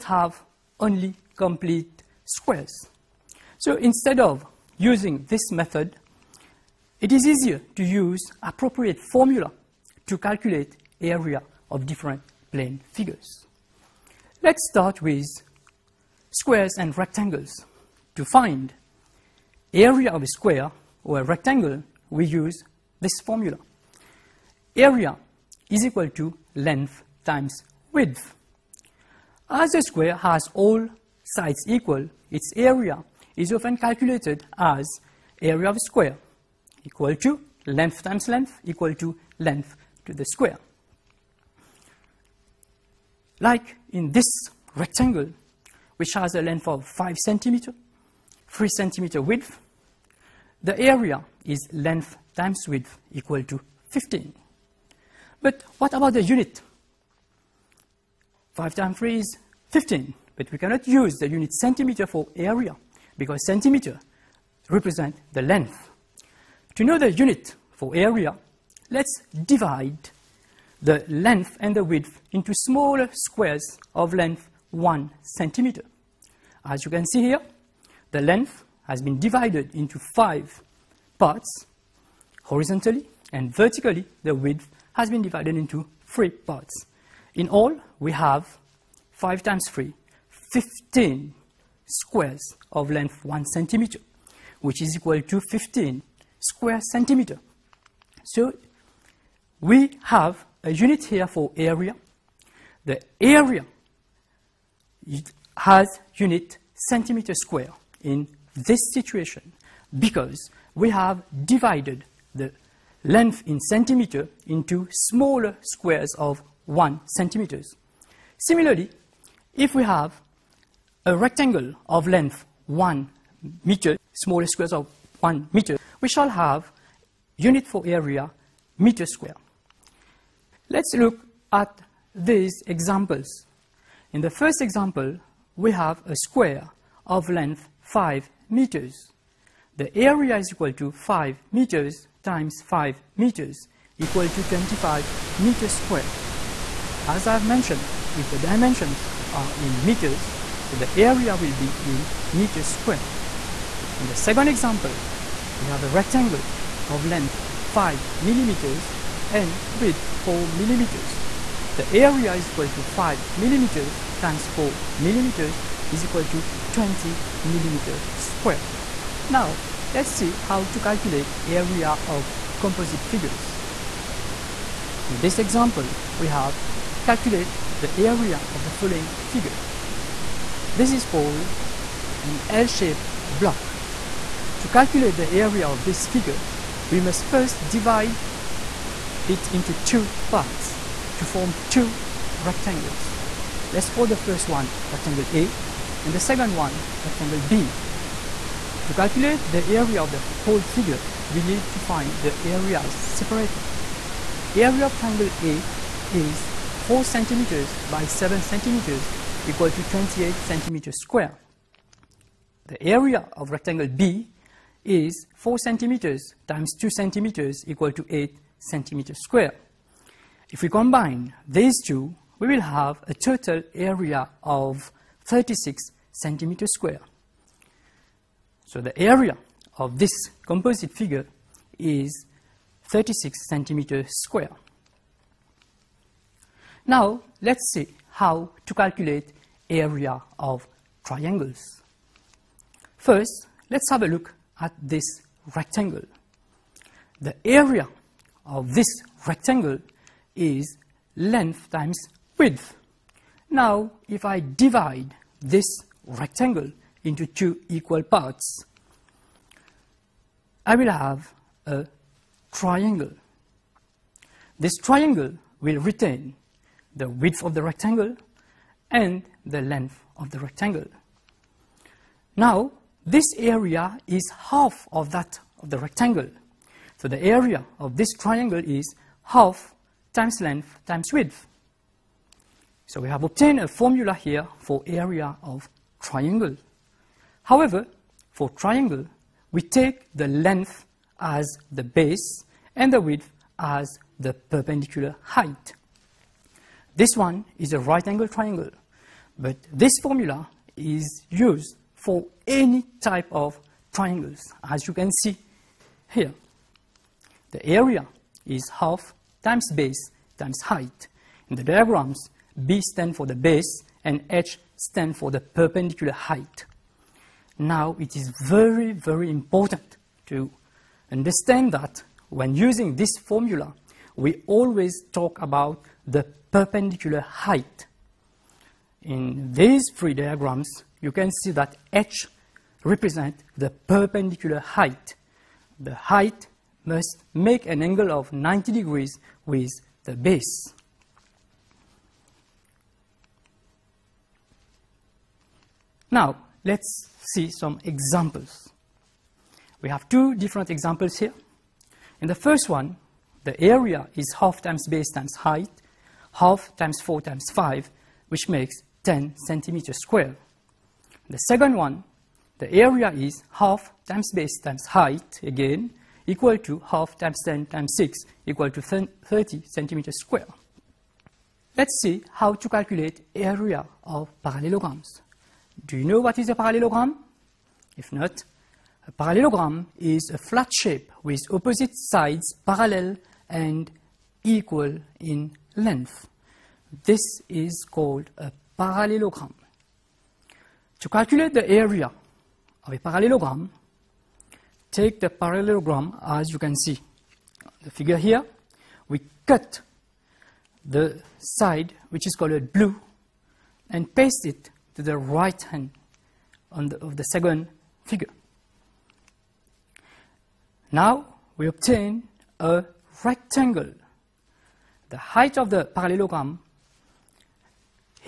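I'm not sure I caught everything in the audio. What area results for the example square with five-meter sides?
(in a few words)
25 meters square.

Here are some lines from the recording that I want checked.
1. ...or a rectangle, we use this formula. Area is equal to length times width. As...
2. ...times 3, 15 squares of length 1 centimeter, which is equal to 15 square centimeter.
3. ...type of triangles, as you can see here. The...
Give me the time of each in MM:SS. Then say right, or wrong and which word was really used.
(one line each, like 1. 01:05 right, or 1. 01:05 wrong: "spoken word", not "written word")
1. 00:21 right
2. 01:29 right
3. 05:03 right.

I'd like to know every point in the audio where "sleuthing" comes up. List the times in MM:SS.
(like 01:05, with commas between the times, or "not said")
not said.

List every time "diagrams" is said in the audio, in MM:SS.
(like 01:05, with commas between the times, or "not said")
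05:11, 05:30.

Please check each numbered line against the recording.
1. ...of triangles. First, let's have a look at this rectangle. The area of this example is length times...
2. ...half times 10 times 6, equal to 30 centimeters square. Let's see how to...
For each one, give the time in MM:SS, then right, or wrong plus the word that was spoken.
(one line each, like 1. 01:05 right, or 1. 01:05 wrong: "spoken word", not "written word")
1. 04:00 wrong: "rectangle", not "example"
2. 06:06 right.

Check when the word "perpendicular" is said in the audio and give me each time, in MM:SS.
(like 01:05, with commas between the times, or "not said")
04:54, 05:15, 05:26, 05:33.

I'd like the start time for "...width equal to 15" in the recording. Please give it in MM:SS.
00:52.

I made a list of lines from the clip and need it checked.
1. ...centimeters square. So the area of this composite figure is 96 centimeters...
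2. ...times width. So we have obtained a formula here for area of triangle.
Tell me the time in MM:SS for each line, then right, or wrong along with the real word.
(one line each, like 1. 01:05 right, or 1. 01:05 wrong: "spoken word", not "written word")
1. 03:46 wrong: "36", not "96"
2. 04:40 right.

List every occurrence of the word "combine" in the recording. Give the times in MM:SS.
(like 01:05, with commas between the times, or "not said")
03:40.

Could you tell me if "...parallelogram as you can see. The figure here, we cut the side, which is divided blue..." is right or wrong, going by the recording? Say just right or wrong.
wrong.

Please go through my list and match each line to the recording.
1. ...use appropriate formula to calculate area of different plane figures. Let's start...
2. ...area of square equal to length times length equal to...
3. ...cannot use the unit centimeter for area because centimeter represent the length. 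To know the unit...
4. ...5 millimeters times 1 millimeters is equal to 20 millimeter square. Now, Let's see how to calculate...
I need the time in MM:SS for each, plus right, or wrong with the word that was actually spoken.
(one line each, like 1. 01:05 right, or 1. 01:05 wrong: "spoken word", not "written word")
1. 00:07 right
2. 00:35 right
3. 01:00 right
4. 02:42 wrong: "4", not "1".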